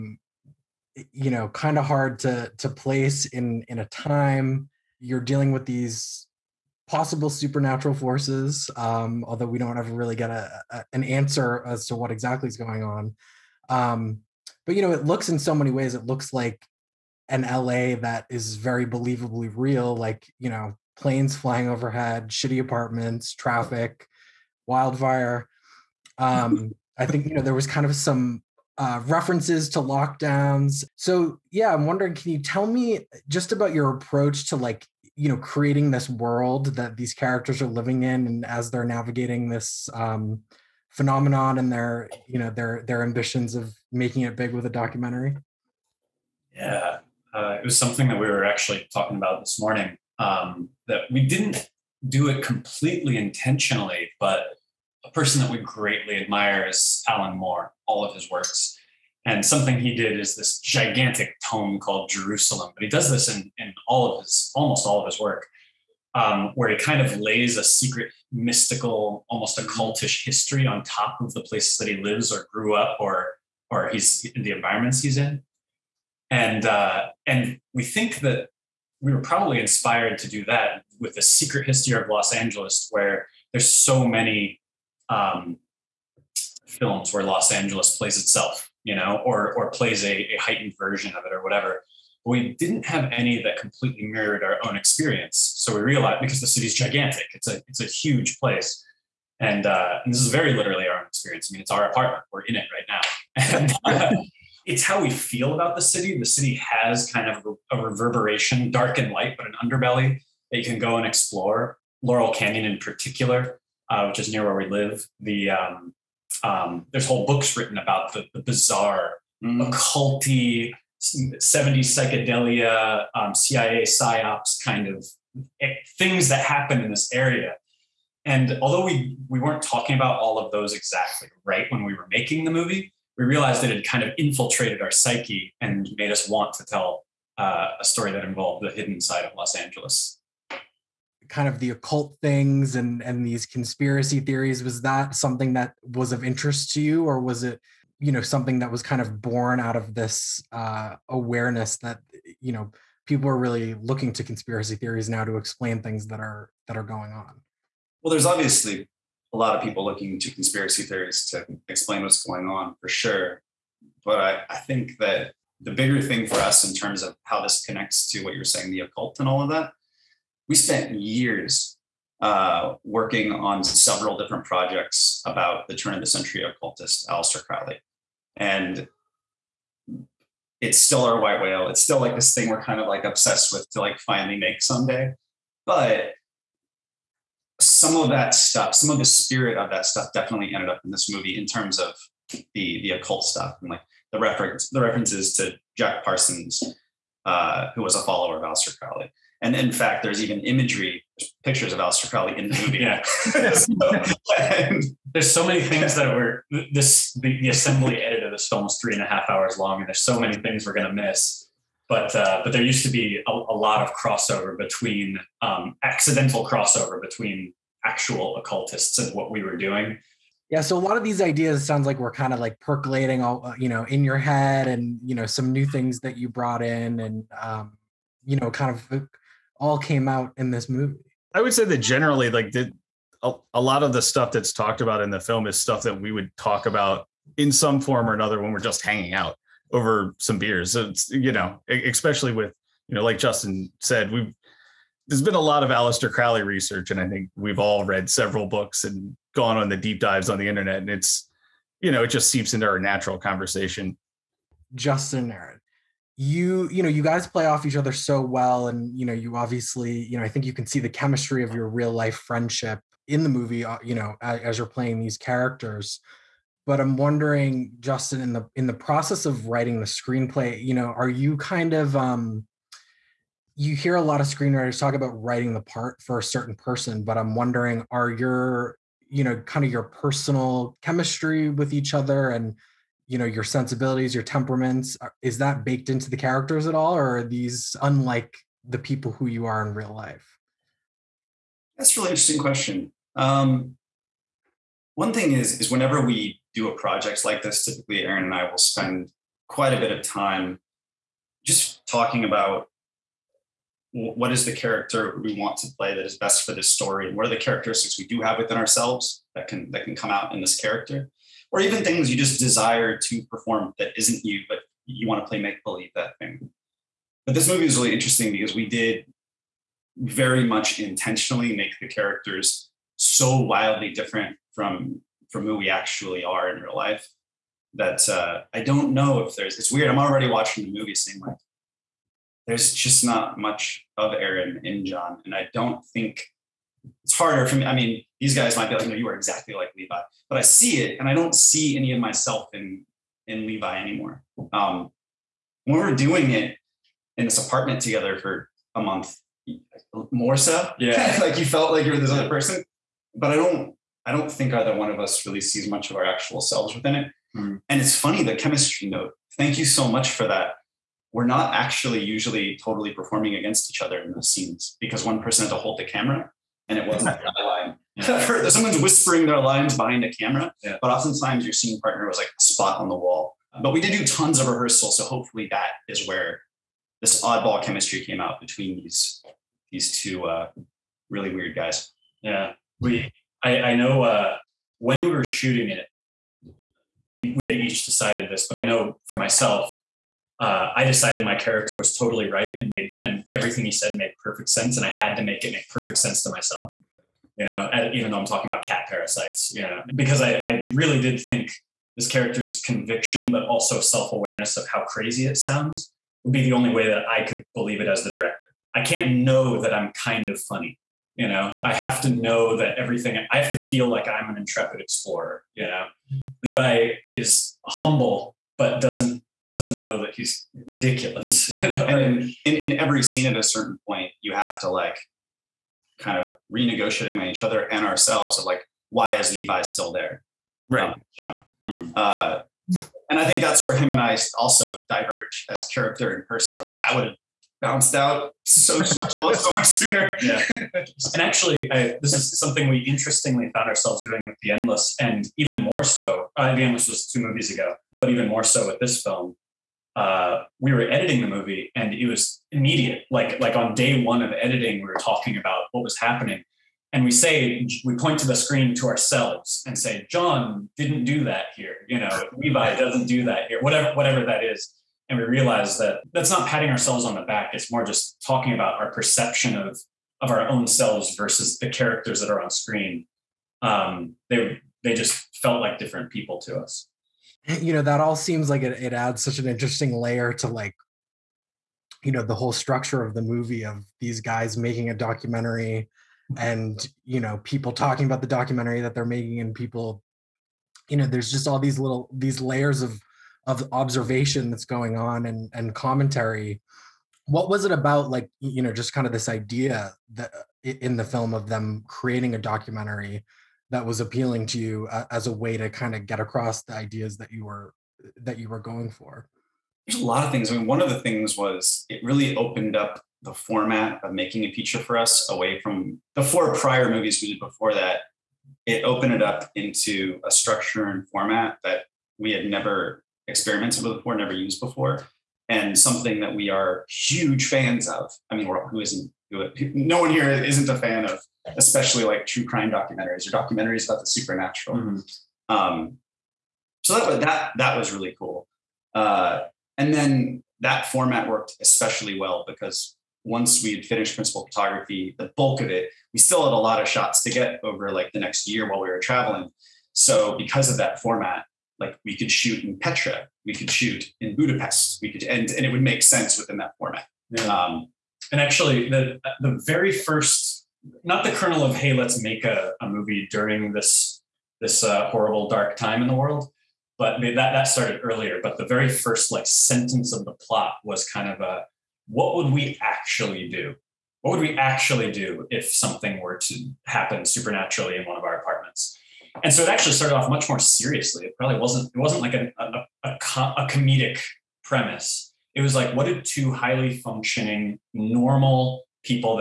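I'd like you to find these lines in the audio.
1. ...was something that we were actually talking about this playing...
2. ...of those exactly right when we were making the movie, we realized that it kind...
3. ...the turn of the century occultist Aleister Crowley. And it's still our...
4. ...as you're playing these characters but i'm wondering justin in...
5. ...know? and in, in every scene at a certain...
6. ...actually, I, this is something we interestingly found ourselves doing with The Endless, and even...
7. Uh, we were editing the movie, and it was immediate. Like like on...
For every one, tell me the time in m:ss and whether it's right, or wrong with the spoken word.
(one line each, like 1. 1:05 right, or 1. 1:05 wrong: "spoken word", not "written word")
1. 0:47 wrong: "morning", not "playing"
2. 2:10 right
3. 2:55 right
4. 4:24 right
5. 7:01 right
6. 7:21 right
7. 7:29 right.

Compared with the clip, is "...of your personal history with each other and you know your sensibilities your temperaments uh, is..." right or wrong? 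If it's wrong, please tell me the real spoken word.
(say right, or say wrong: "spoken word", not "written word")
wrong: "chemistry", not "history".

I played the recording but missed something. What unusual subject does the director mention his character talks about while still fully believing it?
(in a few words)
cat parasites.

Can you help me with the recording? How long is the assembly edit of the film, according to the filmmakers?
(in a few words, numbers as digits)
3 and a half hours.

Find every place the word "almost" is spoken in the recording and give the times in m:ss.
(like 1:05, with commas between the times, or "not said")
1:04, 1:09.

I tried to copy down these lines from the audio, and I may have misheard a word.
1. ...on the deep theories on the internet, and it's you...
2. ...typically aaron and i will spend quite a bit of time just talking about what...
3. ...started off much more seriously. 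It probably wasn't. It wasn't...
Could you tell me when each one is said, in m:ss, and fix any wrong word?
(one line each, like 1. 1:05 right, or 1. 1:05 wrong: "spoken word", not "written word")
1. 4:09 wrong: "dives", not "theories"
2. 4:57 right
3. 9:39 right.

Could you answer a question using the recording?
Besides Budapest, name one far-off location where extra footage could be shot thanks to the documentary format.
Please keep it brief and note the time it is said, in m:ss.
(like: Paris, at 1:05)
Petra, at 9:12.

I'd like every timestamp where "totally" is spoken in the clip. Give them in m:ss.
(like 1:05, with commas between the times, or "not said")
6:02, 6:31.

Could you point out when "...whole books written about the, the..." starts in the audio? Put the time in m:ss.
1:57.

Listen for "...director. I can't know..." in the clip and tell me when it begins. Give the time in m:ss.
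6:48.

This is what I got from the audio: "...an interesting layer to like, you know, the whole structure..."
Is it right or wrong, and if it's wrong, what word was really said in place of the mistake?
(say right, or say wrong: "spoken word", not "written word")
right.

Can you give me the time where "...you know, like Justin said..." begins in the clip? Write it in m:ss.
4:02.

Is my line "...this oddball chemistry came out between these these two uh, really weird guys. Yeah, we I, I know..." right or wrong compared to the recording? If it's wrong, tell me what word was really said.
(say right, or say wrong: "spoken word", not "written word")
right.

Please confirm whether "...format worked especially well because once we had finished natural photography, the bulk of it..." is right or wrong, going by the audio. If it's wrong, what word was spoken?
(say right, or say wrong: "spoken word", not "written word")
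wrong: "principal", not "natural".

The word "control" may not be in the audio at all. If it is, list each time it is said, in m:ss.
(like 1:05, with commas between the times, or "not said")
not said.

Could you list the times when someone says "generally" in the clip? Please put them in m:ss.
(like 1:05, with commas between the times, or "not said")
3:51.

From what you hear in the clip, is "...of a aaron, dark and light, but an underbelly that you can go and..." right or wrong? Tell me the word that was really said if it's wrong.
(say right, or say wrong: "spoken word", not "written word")
wrong: "reverberation", not "aaron".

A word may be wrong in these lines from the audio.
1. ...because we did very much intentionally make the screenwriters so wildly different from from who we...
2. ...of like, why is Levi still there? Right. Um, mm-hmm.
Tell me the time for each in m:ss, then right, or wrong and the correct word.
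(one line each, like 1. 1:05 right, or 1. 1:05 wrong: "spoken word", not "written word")
1. 5:18 wrong: "characters", not "screenwriters"
2. 7:08 right.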